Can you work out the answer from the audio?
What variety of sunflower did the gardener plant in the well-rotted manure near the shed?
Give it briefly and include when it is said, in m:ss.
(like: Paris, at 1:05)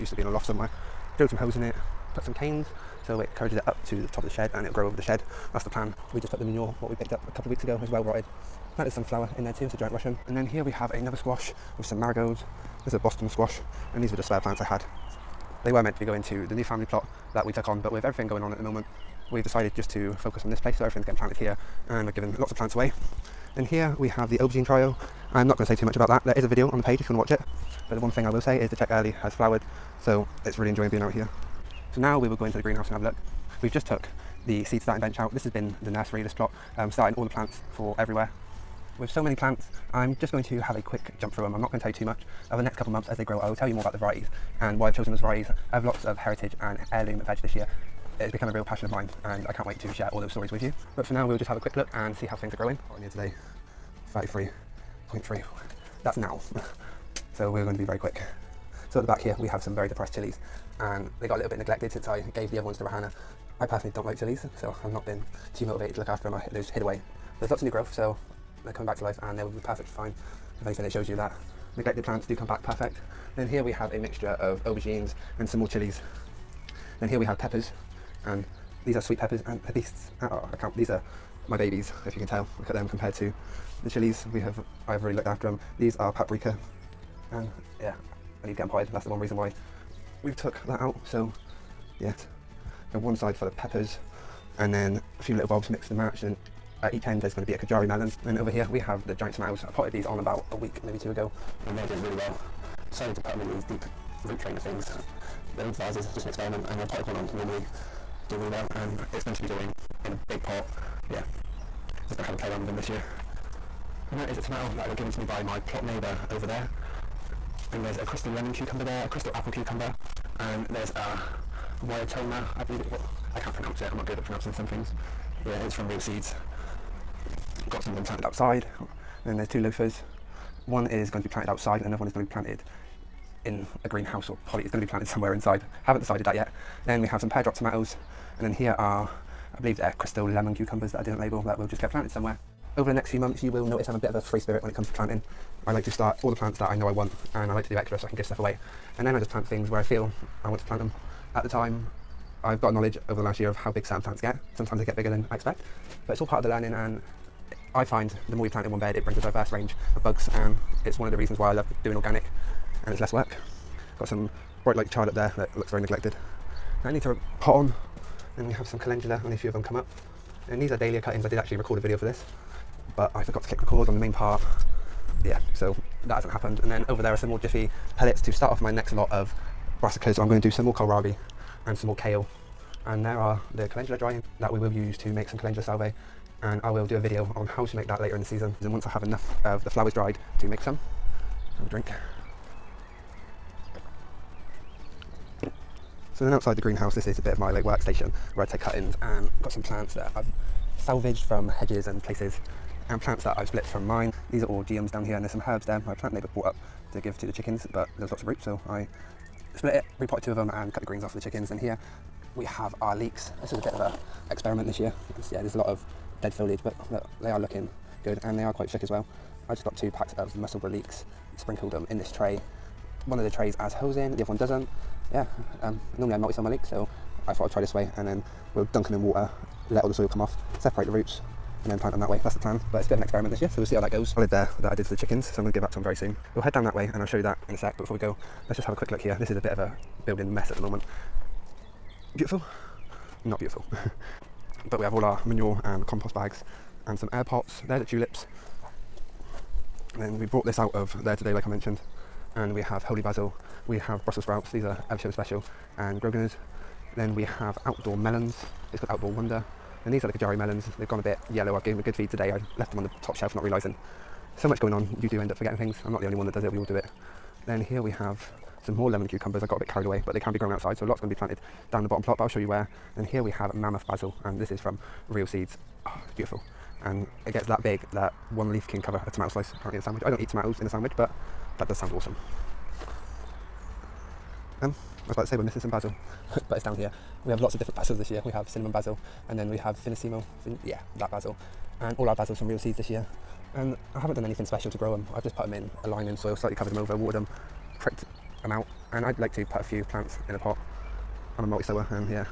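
Giant Russian, at 0:09.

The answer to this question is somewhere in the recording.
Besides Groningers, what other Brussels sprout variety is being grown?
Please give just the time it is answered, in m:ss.
4:14.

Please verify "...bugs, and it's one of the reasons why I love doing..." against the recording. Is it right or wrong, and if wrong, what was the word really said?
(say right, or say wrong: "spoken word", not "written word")
right.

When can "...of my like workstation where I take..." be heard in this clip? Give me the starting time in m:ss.
3:17.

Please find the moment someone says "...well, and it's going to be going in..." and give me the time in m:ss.
1:48.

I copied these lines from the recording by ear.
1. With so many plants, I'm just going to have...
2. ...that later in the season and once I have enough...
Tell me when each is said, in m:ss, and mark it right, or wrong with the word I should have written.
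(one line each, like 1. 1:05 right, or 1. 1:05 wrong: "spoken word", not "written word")
1. 0:38 right
2. 3:07 right.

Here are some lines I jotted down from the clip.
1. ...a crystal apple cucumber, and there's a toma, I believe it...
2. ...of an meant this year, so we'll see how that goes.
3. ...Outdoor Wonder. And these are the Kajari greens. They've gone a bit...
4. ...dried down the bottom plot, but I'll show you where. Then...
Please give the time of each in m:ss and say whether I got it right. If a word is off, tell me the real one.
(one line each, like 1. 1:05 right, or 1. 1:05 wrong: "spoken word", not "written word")
1. 1:59 right
2. 3:52 wrong: "experiment", not "meant"
3. 4:18 wrong: "melons", not "greens"
4. 4:31 wrong: "planted", not "dried".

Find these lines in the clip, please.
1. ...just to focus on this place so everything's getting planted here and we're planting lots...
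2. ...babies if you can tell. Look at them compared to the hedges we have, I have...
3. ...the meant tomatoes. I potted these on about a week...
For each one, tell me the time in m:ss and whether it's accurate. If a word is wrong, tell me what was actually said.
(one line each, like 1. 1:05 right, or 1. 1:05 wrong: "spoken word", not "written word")
1. 0:19 wrong: "giving", not "planting"
2. 1:21 wrong: "chilies", not "hedges"
3. 1:39 wrong: "giant", not "meant".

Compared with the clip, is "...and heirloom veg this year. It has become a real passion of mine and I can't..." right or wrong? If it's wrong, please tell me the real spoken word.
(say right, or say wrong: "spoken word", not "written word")
right.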